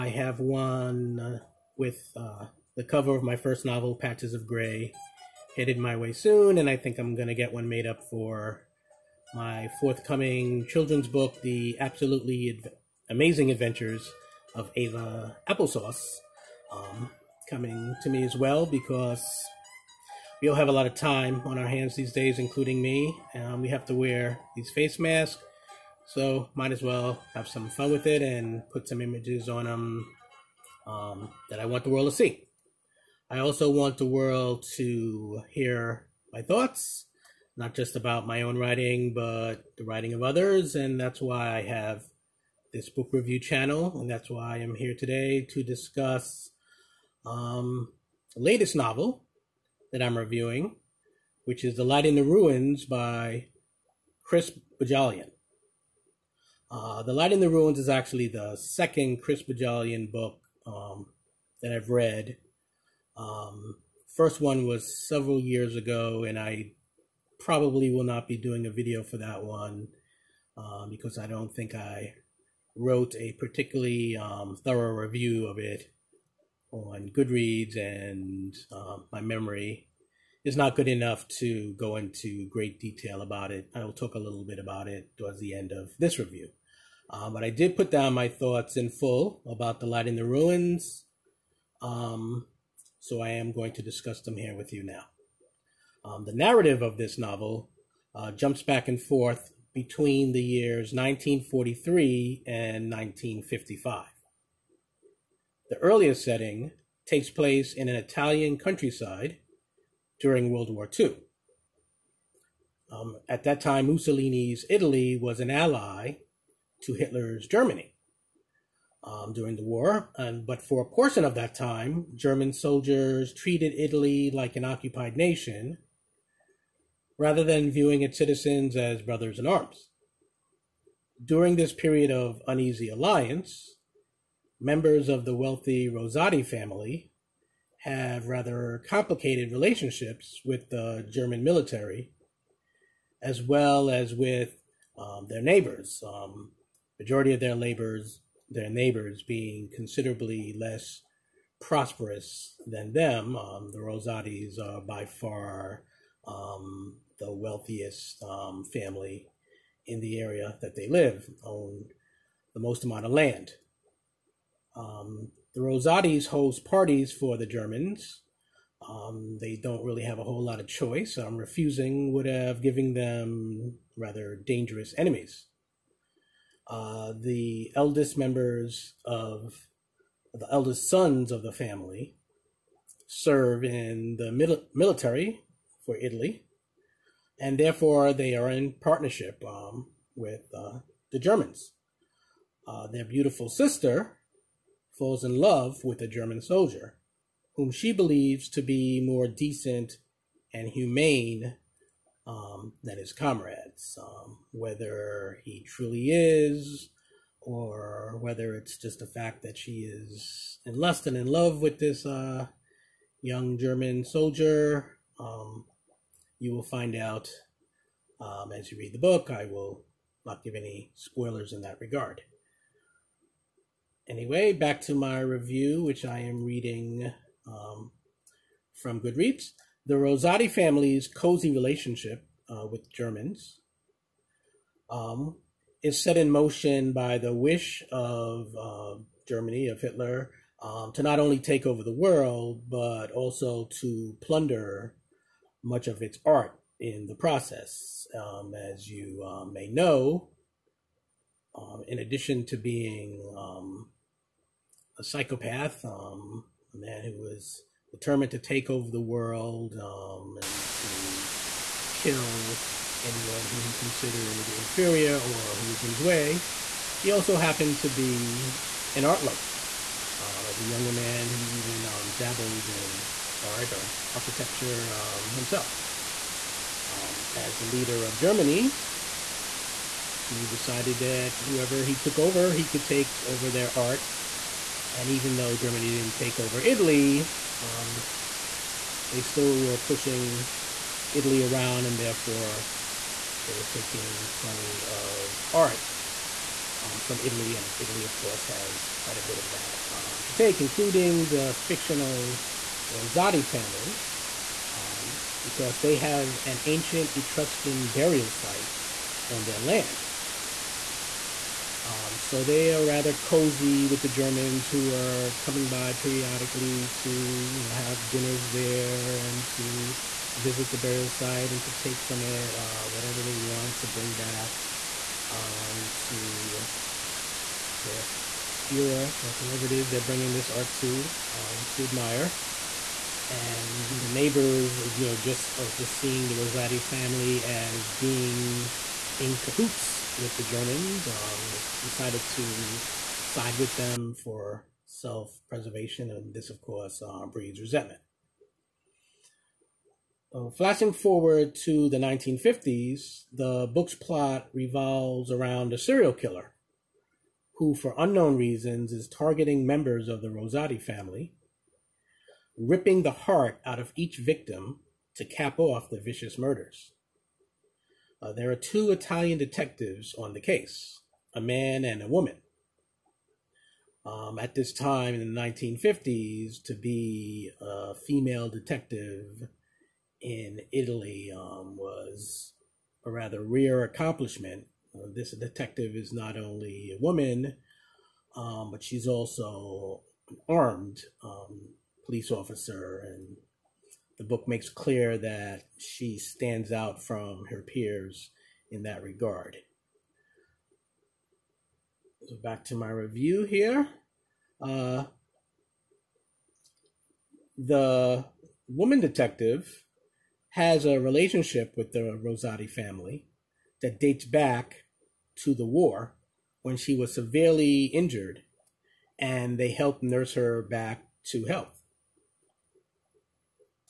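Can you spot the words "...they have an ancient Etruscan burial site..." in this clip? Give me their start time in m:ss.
5:05.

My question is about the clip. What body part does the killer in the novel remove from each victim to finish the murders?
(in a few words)
heart.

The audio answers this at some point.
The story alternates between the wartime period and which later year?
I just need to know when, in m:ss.
1:42.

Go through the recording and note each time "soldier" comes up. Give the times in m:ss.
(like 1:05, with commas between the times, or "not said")
2:02, 3:16, 3:34.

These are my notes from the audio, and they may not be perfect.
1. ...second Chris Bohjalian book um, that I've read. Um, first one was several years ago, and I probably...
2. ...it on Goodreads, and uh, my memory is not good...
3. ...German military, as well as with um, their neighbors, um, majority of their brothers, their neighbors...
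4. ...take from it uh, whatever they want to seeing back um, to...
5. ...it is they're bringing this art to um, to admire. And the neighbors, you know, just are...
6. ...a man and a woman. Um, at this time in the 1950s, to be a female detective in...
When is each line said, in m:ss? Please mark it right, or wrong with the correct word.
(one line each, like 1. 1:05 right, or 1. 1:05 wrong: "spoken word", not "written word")
1. 0:58 right
2. 1:15 right
3. 2:21 wrong: "labors", not "brothers"
4. 5:21 wrong: "bring", not "seeing"
5. 5:29 right
6. 6:11 right.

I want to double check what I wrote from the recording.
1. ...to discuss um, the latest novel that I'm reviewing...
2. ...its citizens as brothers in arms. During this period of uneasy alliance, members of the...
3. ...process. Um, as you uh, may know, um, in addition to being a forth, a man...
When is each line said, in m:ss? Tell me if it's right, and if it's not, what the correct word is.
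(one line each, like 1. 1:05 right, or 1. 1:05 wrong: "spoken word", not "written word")
1. 0:45 right
2. 2:08 right
3. 4:07 wrong: "psychopath", not "forth".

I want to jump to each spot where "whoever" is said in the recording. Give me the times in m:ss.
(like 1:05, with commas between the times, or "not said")
4:41, 5:29.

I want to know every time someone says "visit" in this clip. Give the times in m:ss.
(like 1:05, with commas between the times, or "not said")
5:20.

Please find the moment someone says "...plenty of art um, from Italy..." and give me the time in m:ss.
4:54.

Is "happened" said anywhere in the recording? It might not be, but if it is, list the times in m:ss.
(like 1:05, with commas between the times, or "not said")
4:27.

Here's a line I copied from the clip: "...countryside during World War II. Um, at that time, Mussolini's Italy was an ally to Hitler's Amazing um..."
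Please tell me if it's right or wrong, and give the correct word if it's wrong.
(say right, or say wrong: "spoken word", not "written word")
wrong: "Germany", not "Amazing".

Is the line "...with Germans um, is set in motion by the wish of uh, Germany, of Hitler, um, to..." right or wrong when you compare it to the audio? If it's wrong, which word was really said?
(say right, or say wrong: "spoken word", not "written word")
right.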